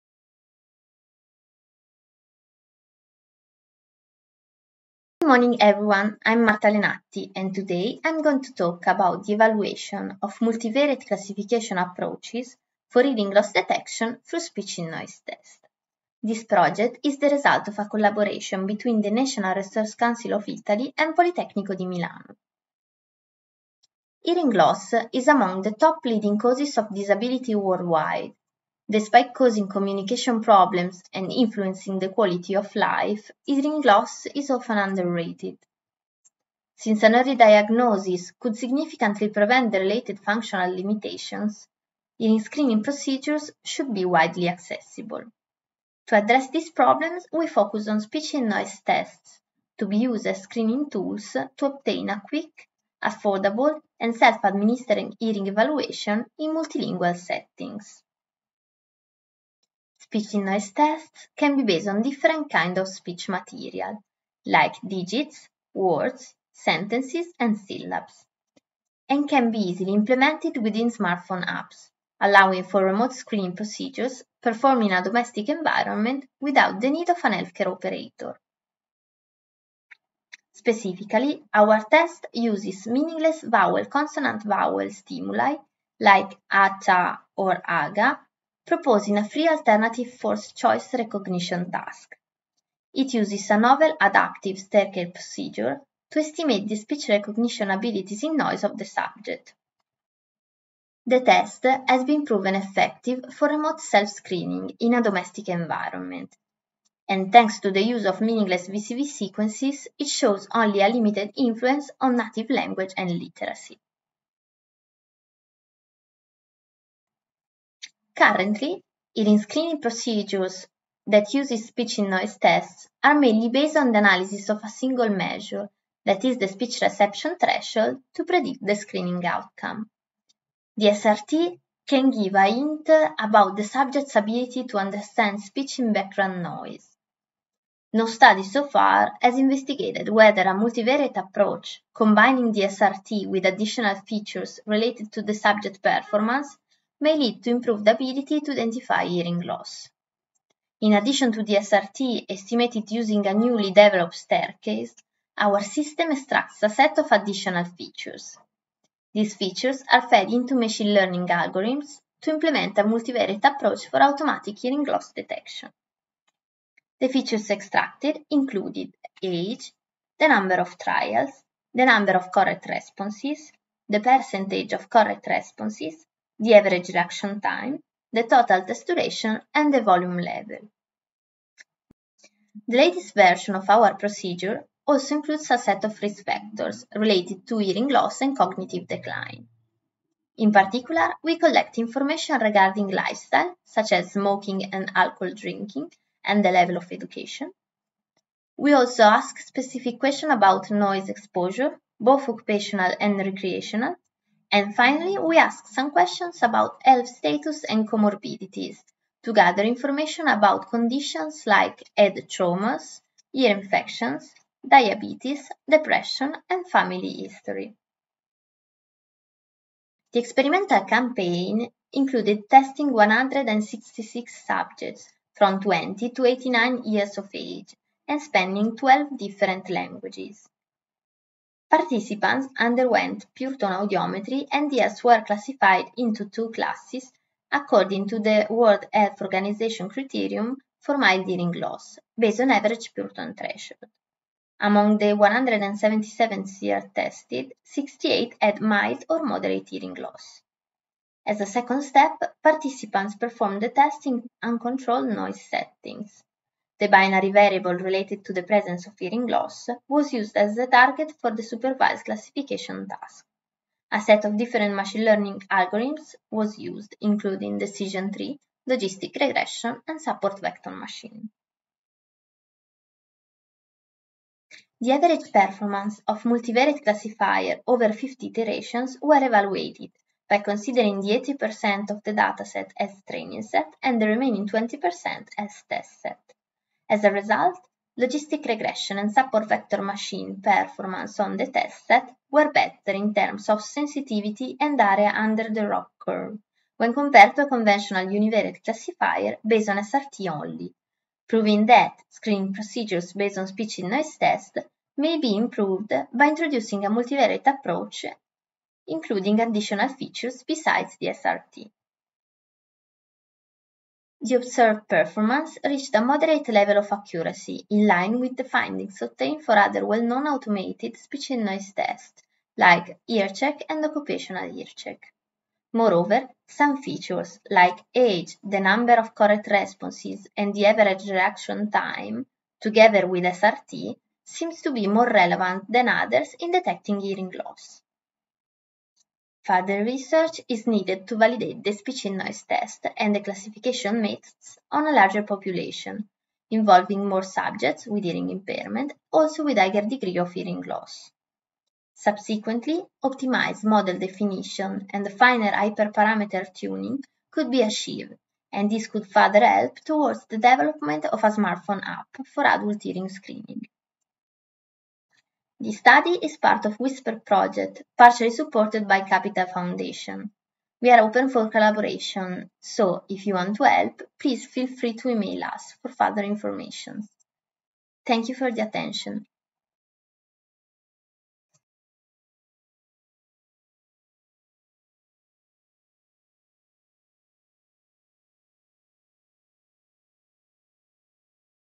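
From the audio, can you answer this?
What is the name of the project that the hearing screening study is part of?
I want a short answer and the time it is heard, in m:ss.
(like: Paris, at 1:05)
Whisper, at 6:06.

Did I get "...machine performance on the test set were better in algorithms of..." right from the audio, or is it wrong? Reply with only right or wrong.
wrong.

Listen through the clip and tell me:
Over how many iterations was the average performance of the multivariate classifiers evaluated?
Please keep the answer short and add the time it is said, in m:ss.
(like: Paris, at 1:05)
50, at 4:37.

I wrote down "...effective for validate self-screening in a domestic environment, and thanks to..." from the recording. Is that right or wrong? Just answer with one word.
wrong.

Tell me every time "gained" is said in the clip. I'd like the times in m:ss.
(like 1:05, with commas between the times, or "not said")
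not said.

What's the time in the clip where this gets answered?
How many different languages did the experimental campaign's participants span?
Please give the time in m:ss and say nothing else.
3:48.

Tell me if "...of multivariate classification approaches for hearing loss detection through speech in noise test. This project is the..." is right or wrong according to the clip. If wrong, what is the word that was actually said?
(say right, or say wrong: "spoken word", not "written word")
right.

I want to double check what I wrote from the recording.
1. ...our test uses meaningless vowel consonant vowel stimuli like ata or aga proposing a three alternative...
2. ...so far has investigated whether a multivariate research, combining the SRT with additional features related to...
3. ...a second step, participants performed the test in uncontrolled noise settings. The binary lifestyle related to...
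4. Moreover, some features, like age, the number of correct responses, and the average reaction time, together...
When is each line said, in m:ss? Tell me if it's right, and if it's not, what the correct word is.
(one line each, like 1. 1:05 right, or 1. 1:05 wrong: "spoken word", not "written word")
1. 1:21 right
2. 2:18 wrong: "approach", not "research"
3. 4:11 wrong: "variable", not "lifestyle"
4. 5:25 right.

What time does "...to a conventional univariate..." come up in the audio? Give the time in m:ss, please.
4:57.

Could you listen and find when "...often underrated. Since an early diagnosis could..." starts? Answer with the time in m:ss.
0:34.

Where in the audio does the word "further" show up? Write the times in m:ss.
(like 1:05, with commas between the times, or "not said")
5:39, 5:59, 6:15.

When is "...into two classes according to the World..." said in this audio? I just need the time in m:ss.
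3:55.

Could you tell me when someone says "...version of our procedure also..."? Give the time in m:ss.
3:03.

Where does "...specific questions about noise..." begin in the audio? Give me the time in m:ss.
3:19.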